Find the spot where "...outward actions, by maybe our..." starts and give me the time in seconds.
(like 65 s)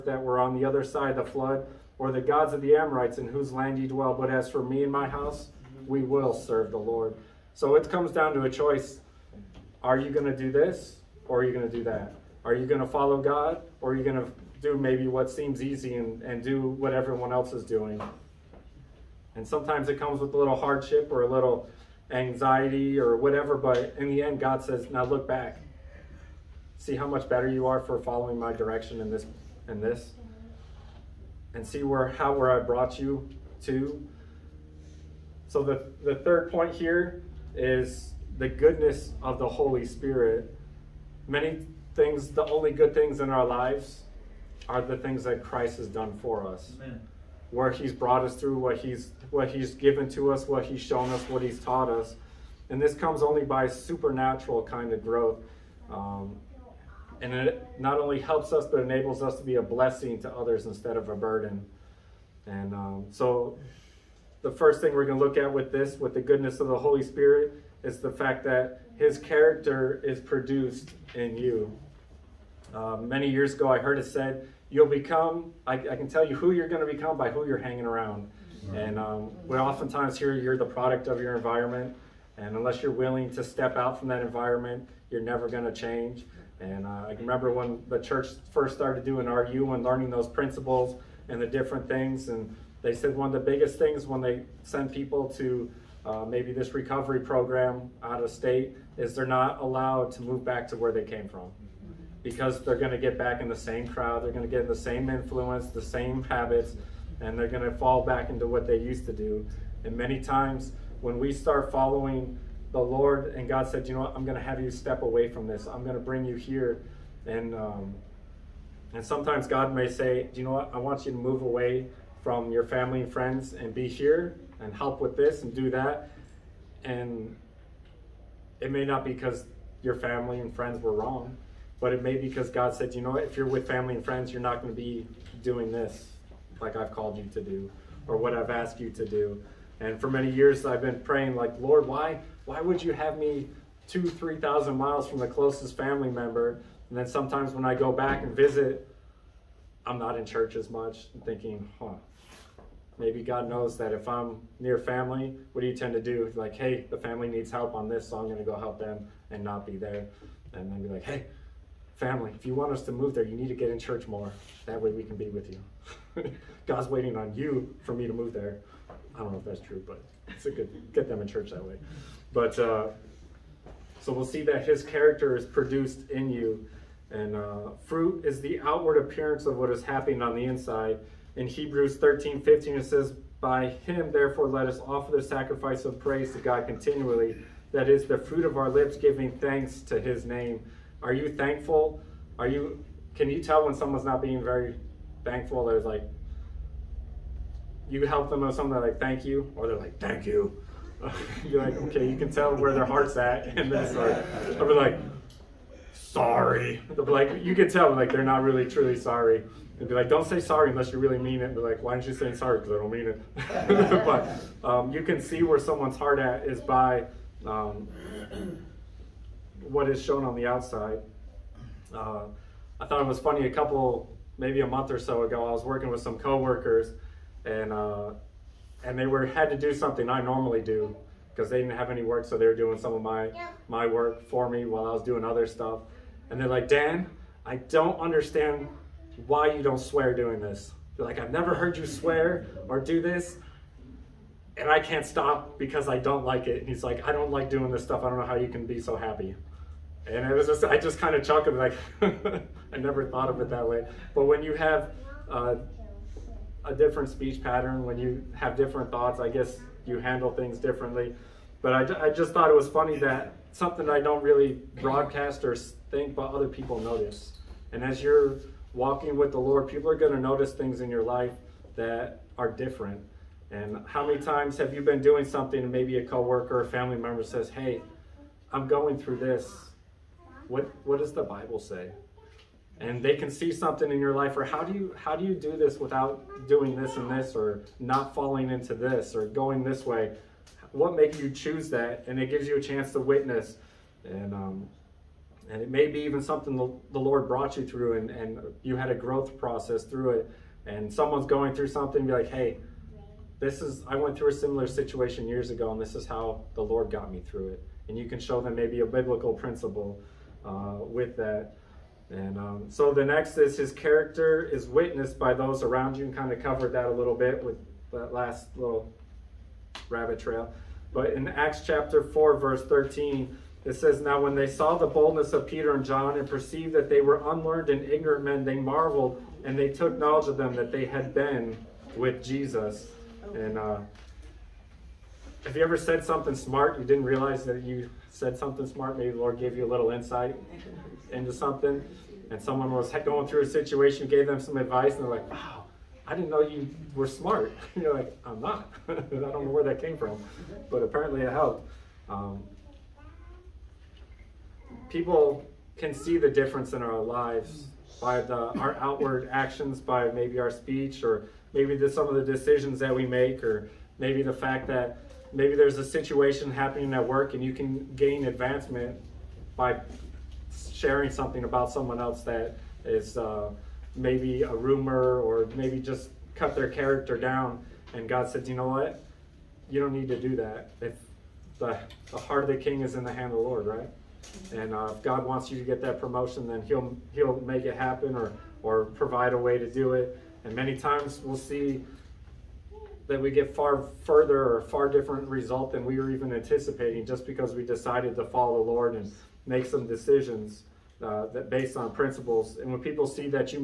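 358 s.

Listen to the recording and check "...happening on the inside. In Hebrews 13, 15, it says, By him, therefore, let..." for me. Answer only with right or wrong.
right.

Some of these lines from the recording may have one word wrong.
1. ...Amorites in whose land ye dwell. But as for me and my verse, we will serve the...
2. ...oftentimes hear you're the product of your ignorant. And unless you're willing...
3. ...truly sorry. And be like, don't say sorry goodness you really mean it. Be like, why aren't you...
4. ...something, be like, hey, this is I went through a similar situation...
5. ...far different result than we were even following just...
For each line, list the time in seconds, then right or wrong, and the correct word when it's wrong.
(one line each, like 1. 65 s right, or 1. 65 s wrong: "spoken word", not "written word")
1. 2 s wrong: "house", not "verse"
2. 79 s wrong: "environment", not "ignorant"
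3. 208 s wrong: "unless", not "goodness"
4. 301 s right
5. 394 s wrong: "anticipating", not "following".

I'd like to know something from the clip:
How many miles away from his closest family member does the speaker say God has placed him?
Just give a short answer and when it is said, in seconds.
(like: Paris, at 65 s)
3,000, at 144 s.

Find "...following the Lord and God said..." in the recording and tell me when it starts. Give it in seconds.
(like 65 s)
111 s.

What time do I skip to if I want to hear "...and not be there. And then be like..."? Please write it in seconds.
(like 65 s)
159 s.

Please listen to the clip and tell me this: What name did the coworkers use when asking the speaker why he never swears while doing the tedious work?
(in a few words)
Dan.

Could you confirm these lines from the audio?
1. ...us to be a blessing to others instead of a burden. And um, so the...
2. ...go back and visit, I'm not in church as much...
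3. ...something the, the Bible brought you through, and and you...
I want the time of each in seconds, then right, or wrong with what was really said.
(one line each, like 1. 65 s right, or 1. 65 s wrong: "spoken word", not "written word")
1. 59 s right
2. 147 s right
3. 296 s wrong: "Lord", not "Bible".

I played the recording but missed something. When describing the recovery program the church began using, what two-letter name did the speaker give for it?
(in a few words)
RU.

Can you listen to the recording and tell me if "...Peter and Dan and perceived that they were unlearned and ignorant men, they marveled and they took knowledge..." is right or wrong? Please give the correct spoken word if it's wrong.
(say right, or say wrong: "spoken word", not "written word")
wrong: "John", not "Dan".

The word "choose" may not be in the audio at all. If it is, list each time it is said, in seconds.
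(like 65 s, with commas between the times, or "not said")
291 s.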